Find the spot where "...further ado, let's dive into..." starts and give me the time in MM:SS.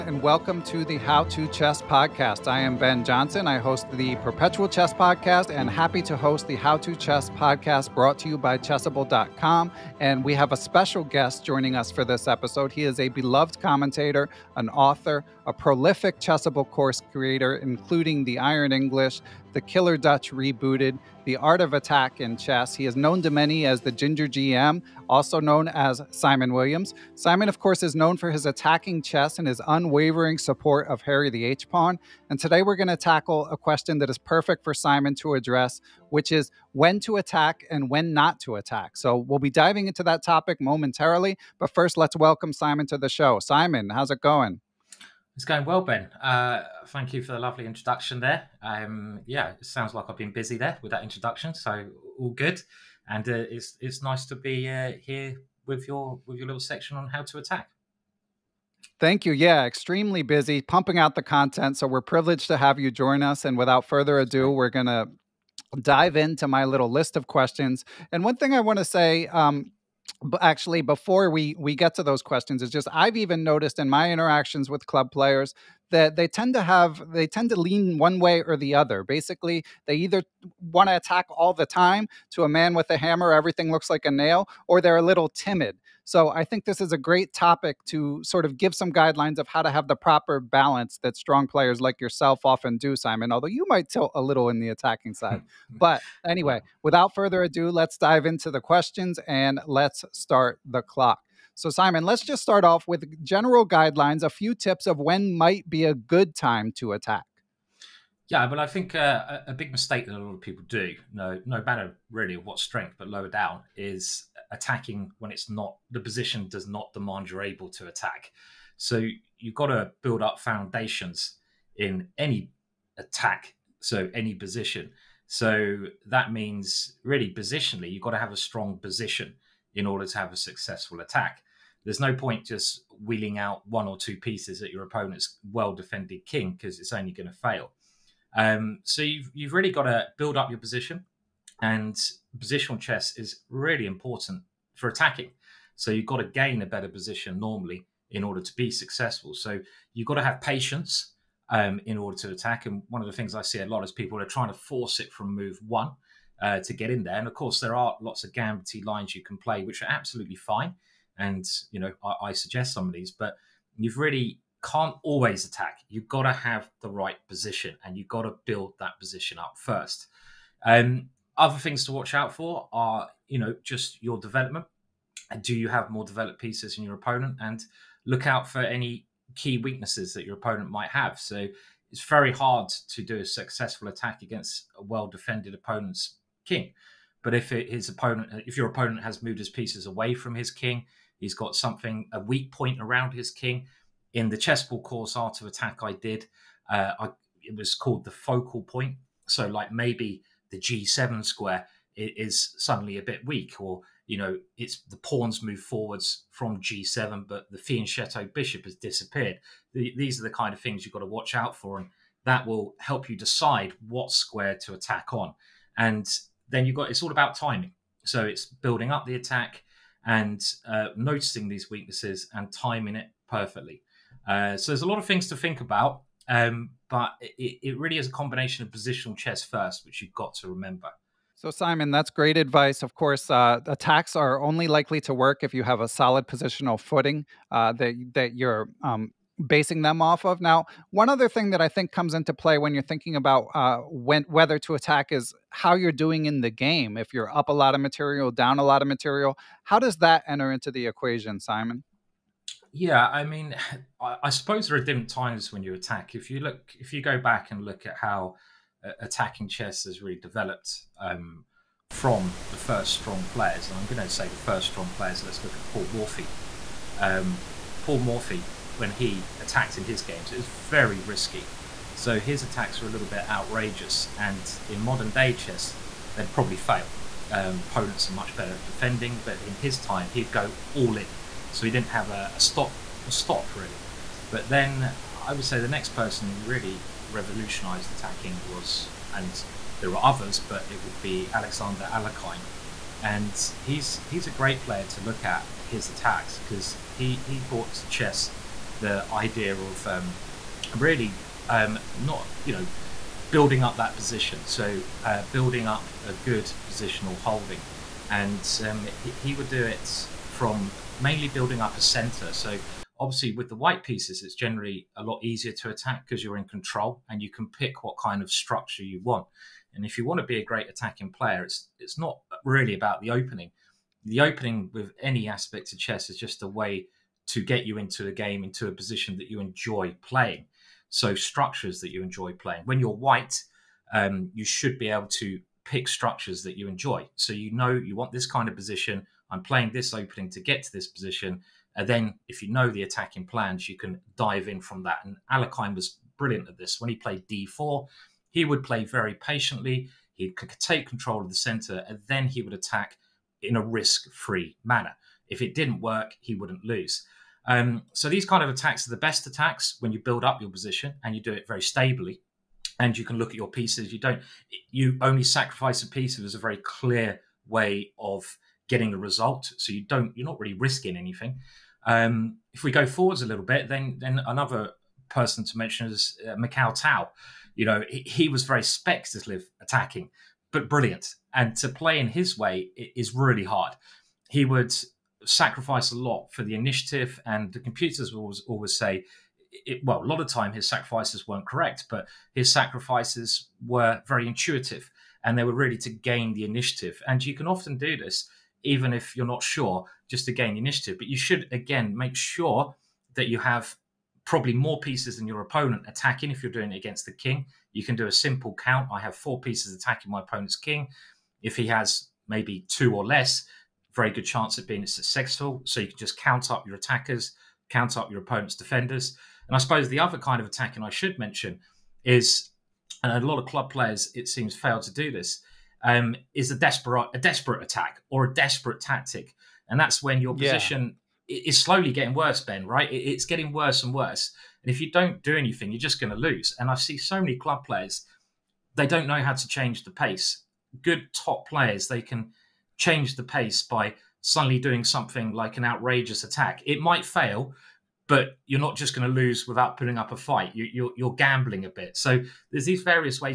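01:37.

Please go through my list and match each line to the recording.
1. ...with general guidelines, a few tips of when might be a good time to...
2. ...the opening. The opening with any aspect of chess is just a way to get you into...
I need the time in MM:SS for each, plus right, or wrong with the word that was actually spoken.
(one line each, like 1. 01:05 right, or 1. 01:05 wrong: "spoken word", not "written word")
1. 01:42 right
2. 05:23 right.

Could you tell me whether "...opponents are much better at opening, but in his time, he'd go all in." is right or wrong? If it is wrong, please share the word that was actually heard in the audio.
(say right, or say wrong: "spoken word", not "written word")
wrong: "defending", not "opening".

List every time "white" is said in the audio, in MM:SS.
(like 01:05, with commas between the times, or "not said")
05:13, 05:32.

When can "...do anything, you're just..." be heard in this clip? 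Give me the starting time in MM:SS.
07:15.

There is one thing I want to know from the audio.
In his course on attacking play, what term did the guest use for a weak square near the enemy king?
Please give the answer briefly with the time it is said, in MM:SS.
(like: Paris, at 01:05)
the focal point, at 03:18.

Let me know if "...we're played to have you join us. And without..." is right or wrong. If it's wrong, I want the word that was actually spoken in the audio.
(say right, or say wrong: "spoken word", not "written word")
wrong: "privileged", not "played".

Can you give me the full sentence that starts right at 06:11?
Um, if we go forwards a little bit, then then another person to mention is uh, Mikhail Tal.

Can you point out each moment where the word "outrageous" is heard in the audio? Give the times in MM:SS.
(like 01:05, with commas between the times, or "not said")
04:33, 07:25.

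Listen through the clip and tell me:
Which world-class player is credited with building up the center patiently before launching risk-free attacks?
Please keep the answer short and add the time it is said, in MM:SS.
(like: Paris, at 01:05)
Alexander Alekhine, at 04:51.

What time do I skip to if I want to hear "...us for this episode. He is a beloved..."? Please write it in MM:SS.
00:11.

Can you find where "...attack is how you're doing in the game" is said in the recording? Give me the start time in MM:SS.
04:04.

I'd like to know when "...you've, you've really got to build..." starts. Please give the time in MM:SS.
02:19.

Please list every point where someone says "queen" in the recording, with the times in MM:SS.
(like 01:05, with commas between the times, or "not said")
not said.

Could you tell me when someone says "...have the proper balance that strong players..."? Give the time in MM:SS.
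01:29.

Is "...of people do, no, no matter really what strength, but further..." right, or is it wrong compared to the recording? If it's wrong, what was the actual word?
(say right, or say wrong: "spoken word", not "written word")
wrong: "lower", not "further".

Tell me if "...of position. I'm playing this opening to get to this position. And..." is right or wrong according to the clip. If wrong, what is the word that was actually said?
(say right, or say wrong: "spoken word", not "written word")
right.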